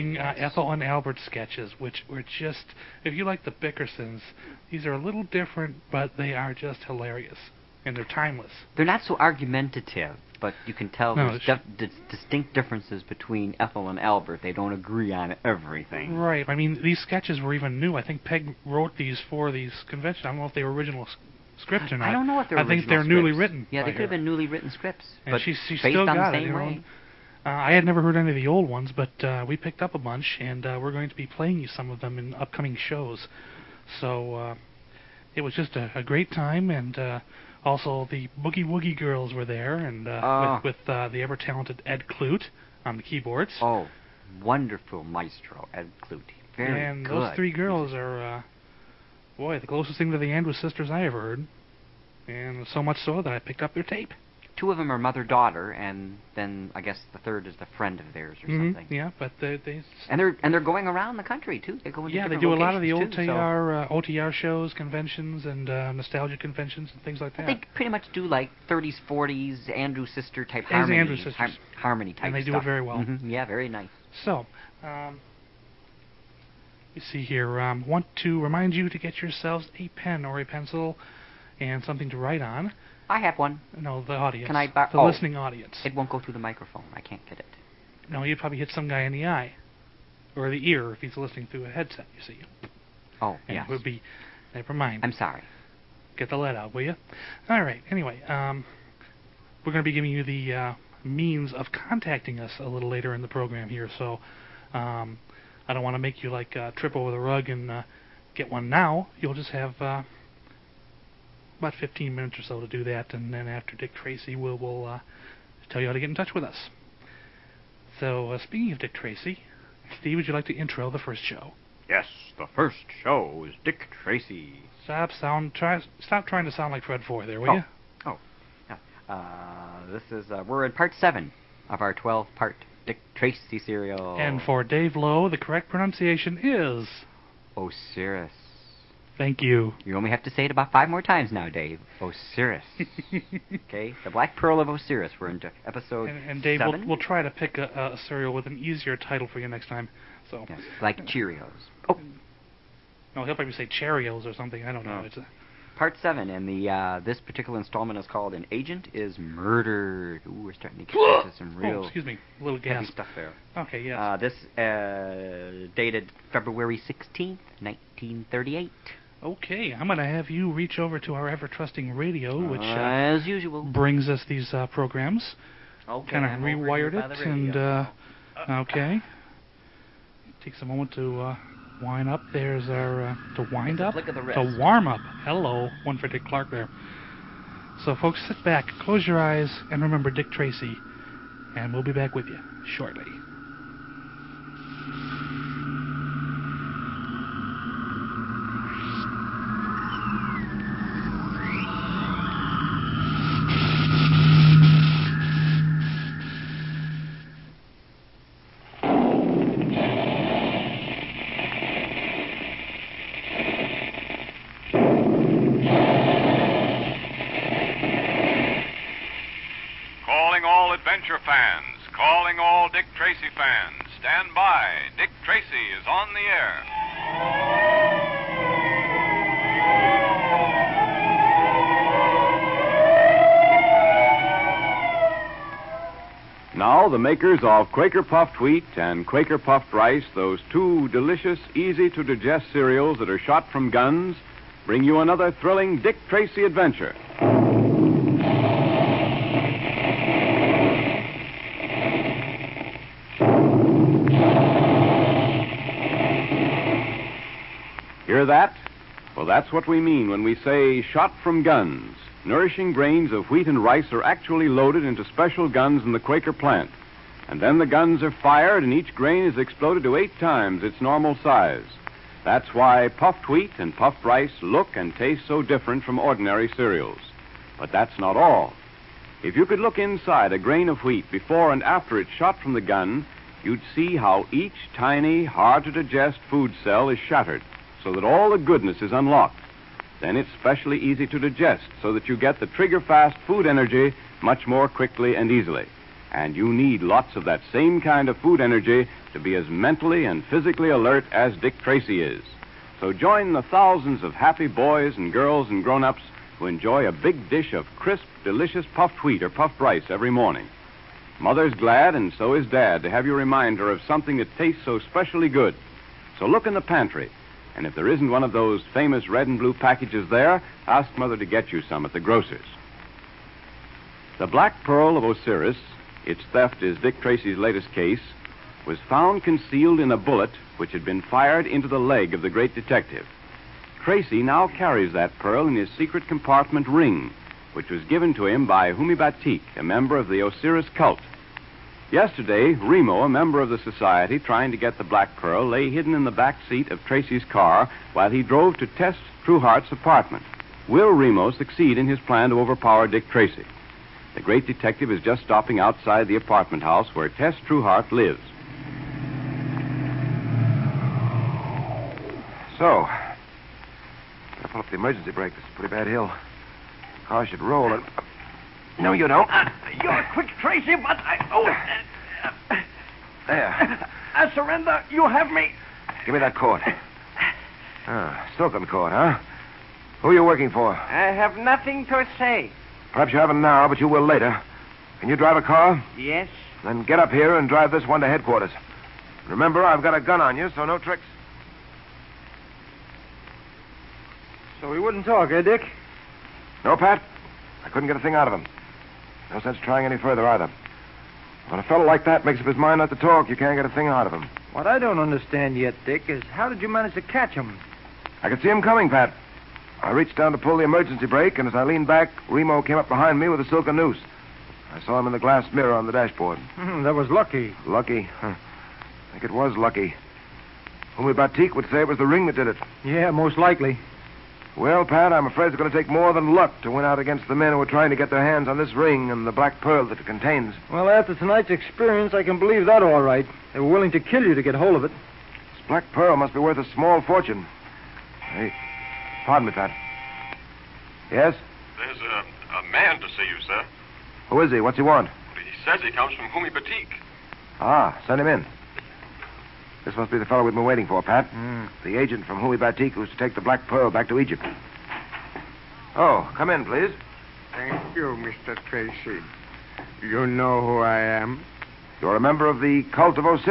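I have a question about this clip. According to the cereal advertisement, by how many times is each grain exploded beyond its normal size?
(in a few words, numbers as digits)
8.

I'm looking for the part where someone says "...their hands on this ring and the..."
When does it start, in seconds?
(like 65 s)
428 s.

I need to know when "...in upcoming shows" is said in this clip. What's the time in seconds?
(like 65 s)
32 s.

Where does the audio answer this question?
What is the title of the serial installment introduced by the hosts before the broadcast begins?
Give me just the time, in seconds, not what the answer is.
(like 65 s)
158 s.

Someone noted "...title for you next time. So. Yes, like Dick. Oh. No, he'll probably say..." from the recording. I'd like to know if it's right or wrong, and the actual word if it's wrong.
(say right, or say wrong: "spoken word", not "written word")
wrong: "Cheerios", not "Dick".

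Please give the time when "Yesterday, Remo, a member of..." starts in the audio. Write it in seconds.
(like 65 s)
341 s.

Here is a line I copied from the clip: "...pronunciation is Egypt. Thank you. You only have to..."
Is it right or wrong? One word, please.
wrong.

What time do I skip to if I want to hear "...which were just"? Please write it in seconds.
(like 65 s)
1 s.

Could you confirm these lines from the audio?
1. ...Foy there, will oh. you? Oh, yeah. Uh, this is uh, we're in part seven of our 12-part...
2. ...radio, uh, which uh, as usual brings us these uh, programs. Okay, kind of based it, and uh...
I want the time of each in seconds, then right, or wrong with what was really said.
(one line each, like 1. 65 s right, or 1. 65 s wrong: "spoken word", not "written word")
1. 127 s right
2. 171 s wrong: "rewired", not "based".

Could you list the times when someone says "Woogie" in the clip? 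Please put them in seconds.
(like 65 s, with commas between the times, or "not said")
38 s.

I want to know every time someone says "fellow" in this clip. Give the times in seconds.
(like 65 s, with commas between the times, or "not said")
401 s, 450 s.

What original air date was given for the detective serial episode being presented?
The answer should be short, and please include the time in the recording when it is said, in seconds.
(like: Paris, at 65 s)
February 16, 1938, at 166 s.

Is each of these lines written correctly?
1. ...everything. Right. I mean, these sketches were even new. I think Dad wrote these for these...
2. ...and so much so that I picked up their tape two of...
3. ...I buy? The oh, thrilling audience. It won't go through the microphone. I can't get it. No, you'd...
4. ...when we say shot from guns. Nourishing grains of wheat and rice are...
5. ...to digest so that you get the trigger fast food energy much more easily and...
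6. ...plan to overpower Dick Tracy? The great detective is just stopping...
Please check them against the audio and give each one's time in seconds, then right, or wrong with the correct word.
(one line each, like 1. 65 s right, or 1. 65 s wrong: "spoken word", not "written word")
1. 15 s wrong: "Peg", not "Dad"
2. 52 s right
3. 84 s wrong: "listening", not "thrilling"
4. 260 s right
5. 291 s wrong: "quickly", not "easily"
6. 351 s right.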